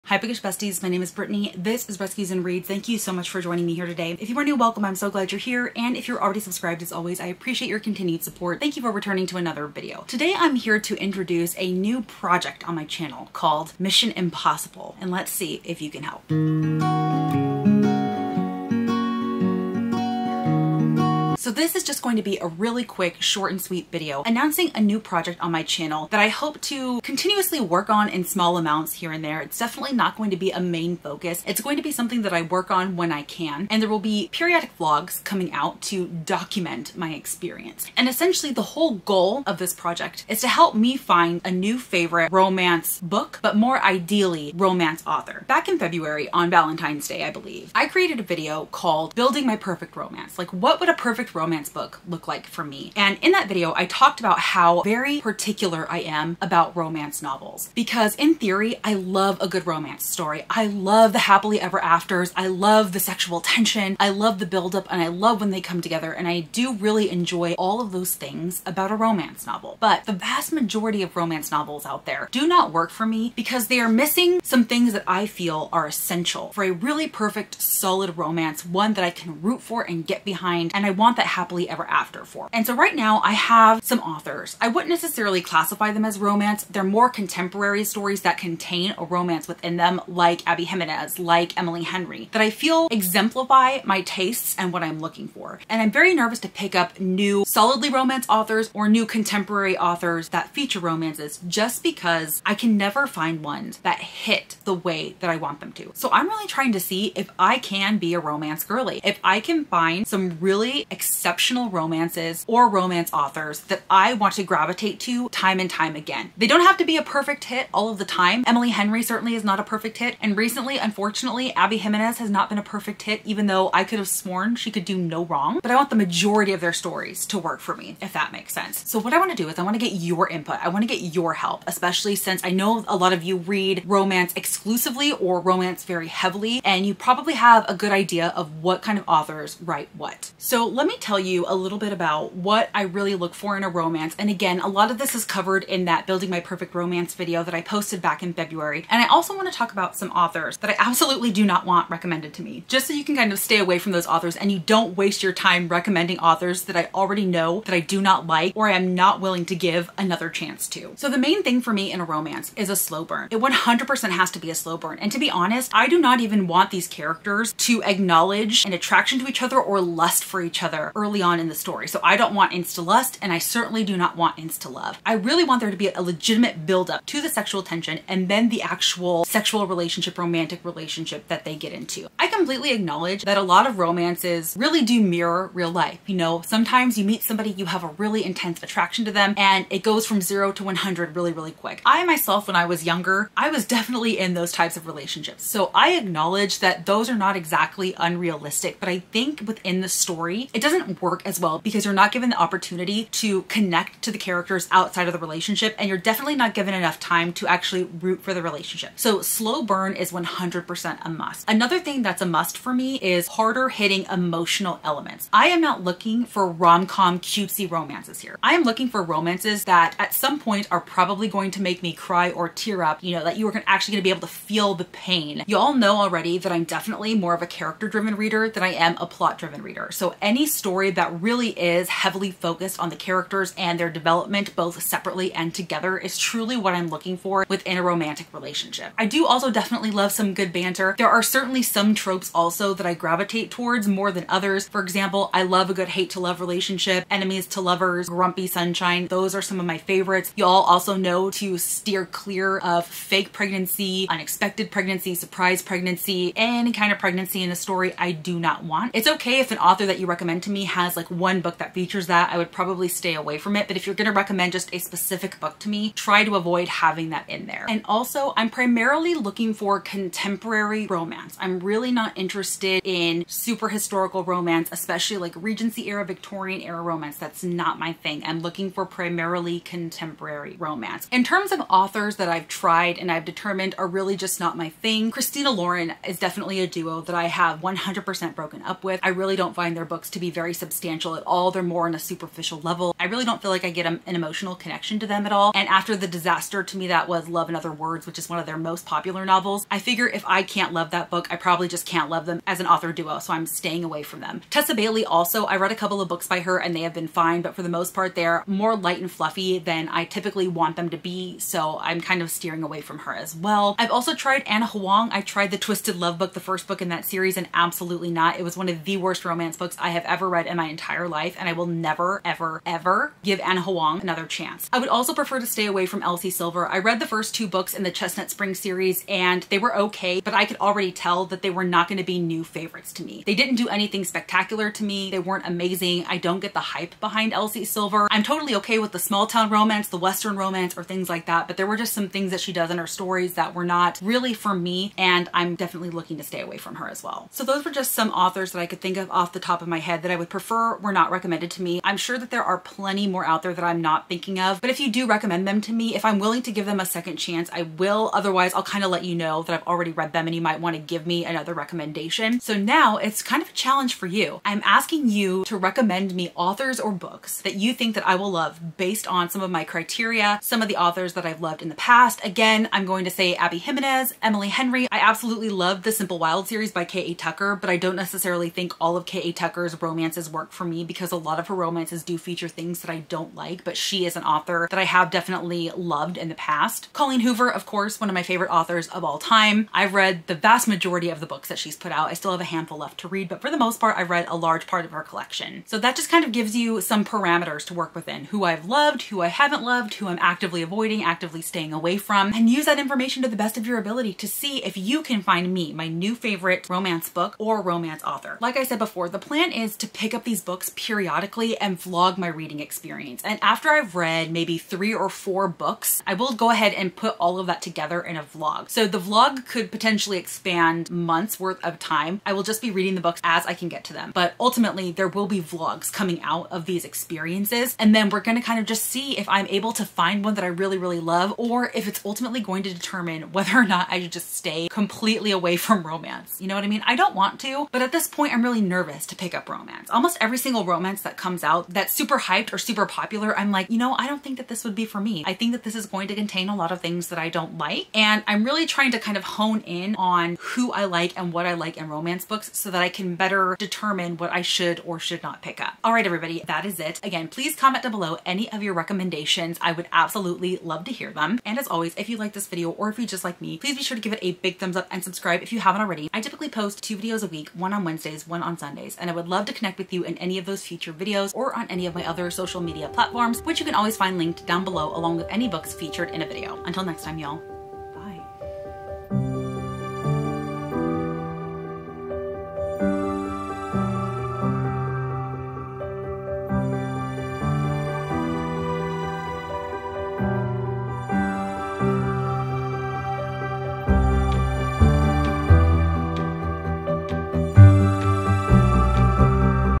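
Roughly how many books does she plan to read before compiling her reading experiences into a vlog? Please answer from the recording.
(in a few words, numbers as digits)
3 or 4.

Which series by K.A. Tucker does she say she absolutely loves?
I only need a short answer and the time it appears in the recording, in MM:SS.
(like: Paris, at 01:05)
The Simple Wild, at 06:15.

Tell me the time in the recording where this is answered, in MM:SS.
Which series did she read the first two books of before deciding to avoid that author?
05:27.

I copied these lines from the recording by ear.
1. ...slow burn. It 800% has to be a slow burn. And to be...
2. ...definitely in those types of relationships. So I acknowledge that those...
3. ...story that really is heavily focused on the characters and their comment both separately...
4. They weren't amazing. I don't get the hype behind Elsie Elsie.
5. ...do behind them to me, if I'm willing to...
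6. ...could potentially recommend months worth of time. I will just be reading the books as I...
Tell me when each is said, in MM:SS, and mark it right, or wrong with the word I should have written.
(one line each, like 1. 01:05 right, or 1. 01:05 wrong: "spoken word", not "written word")
1. 02:42 wrong: "100", not "800"
2. 03:13 right
3. 03:50 wrong: "development", not "comment"
4. 05:35 wrong: "Silver", not "Elsie"
5. 05:54 wrong: "recommend", not "behind"
6. 06:59 wrong: "expand", not "recommend".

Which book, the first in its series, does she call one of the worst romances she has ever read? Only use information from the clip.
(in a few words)
Twisted Love.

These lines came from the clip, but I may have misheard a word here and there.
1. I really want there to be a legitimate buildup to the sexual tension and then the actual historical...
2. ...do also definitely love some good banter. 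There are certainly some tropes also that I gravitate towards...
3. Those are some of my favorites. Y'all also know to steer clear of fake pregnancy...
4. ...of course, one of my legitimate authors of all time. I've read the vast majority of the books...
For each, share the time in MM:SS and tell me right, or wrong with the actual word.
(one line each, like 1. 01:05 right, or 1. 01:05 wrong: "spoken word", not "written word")
1. 02:55 wrong: "sexual", not "historical"
2. 03:59 right
3. 04:09 right
4. 06:27 wrong: "favorite", not "legitimate".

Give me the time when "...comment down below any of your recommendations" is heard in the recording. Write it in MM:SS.
07:37.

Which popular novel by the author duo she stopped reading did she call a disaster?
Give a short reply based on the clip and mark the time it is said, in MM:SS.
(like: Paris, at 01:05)
Love and Other Words, at 04:57.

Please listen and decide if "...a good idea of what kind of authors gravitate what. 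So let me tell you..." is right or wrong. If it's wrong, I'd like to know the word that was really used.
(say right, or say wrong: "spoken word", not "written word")
wrong: "write", not "gravitate".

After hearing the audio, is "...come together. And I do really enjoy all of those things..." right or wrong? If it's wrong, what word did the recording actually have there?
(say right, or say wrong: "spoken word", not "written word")
right.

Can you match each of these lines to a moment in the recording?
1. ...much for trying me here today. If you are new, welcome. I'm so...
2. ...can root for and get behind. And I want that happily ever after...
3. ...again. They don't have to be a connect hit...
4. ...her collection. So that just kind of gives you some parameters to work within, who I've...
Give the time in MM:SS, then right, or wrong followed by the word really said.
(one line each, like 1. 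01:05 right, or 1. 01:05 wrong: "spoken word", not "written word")
1. 00:03 wrong: "joining", not "trying"
2. 01:19 right
3. 01:55 wrong: "perfect", not "connect"
4. 06:34 right.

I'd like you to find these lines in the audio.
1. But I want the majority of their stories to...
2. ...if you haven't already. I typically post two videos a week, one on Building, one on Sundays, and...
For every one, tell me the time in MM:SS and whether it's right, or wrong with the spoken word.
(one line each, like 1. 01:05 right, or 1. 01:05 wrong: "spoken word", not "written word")
1. 02:05 right
2. 07:45 wrong: "Wednesdays", not "Building".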